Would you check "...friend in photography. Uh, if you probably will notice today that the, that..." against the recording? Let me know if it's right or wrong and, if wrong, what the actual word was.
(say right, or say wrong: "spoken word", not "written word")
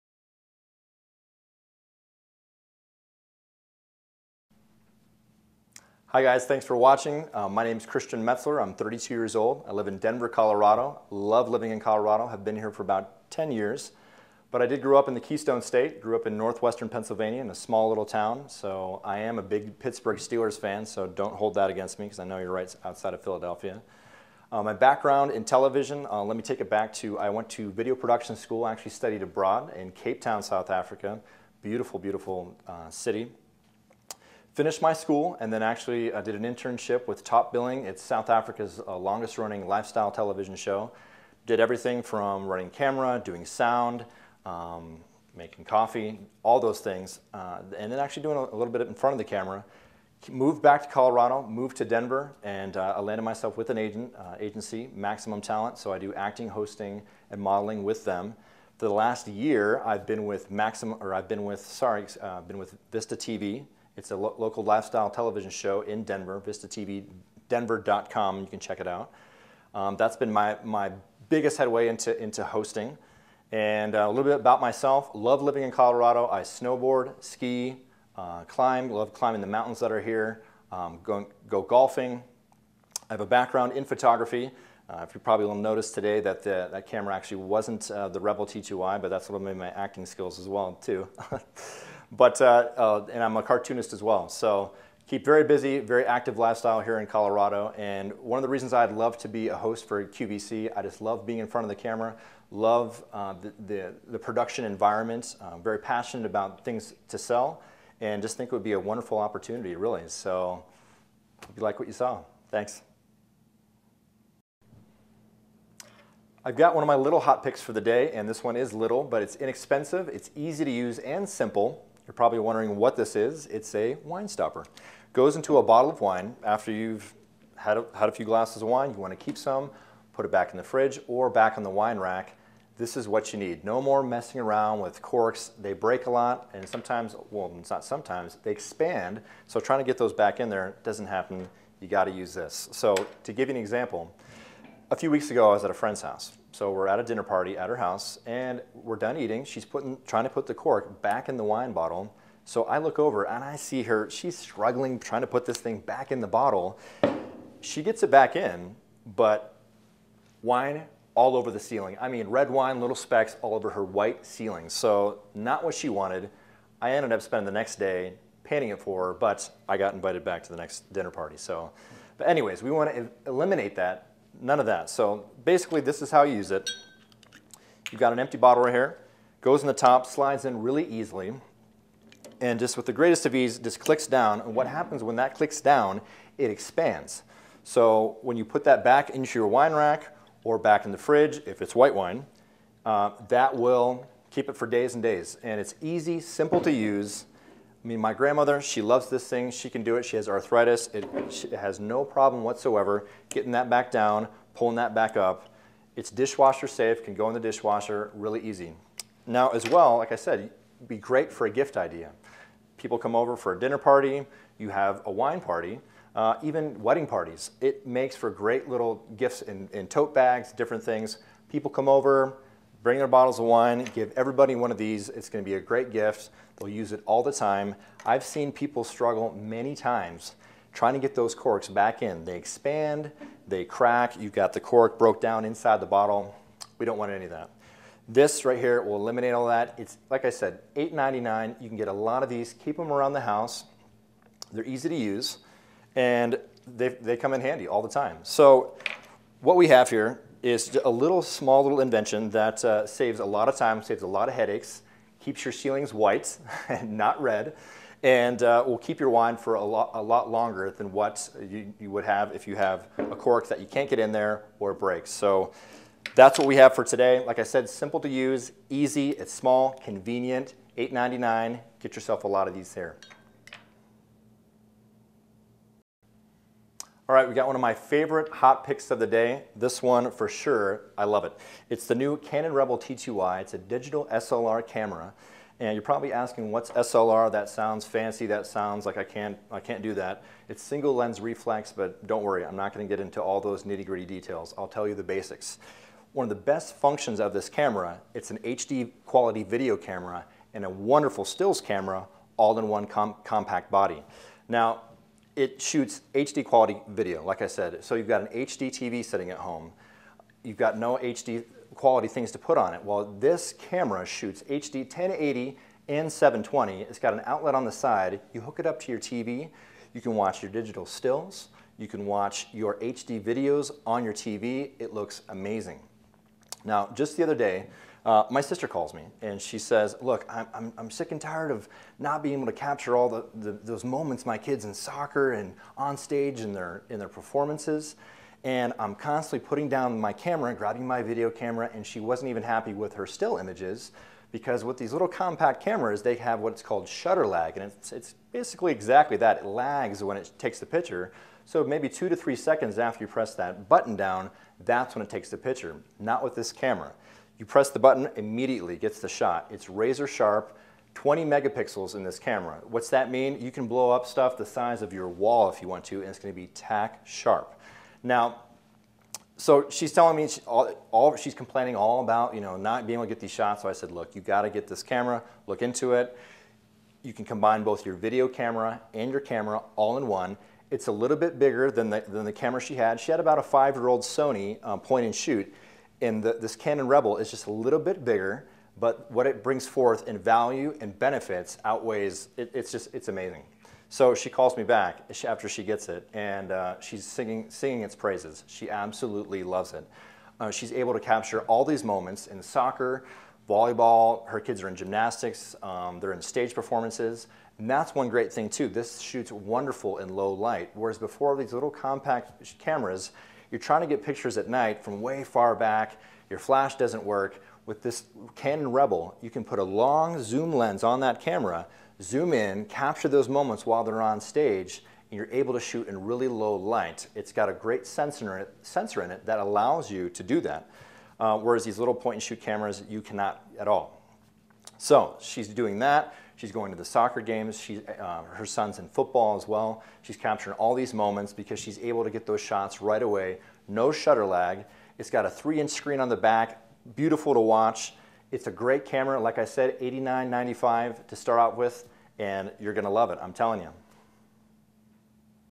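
wrong: "background", not "friend".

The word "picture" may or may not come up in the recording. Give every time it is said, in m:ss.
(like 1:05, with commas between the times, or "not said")
5:50, 5:55, 6:54.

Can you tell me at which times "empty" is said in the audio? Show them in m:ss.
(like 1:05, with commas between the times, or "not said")
2:58.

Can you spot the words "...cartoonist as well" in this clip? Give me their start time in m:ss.
1:33.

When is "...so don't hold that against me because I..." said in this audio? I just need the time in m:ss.
0:20.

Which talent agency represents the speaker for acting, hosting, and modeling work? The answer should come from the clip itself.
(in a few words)
Maximum Talent.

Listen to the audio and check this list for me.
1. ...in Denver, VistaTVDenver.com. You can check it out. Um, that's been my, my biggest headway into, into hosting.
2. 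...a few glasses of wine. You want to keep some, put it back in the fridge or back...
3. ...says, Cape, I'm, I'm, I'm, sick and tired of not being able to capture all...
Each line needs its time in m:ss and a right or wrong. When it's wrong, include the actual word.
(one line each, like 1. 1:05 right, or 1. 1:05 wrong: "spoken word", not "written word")
1. 1:05 right
2. 2:08 right
3. 5:29 wrong: "Look", not "Cape".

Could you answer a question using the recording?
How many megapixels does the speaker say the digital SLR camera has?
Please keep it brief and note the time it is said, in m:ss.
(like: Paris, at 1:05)
20, at 6:00.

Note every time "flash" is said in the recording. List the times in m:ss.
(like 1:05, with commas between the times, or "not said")
6:56.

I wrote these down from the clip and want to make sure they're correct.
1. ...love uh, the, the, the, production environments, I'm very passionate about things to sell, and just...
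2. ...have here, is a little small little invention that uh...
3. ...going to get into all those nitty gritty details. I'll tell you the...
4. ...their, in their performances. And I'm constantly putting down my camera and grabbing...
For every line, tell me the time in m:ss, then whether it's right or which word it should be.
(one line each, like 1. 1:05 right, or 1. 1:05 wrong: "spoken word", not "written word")
1. 1:42 right
2. 4:09 right
3. 4:52 right
4. 5:36 right.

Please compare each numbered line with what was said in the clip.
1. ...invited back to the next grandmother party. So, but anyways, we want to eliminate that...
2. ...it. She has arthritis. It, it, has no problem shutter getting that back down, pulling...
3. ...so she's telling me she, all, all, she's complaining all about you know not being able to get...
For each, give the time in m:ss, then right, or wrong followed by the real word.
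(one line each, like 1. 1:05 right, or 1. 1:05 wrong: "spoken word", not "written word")
1. 2:49 wrong: "dinner", not "grandmother"
2. 3:19 wrong: "whatsoever", not "shutter"
3. 6:09 right.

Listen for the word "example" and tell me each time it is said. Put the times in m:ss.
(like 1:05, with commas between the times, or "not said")
2:23.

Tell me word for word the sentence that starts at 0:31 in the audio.
Beautiful, beautiful uh, city finished my school and then actually uh, did an internship with Top Billing.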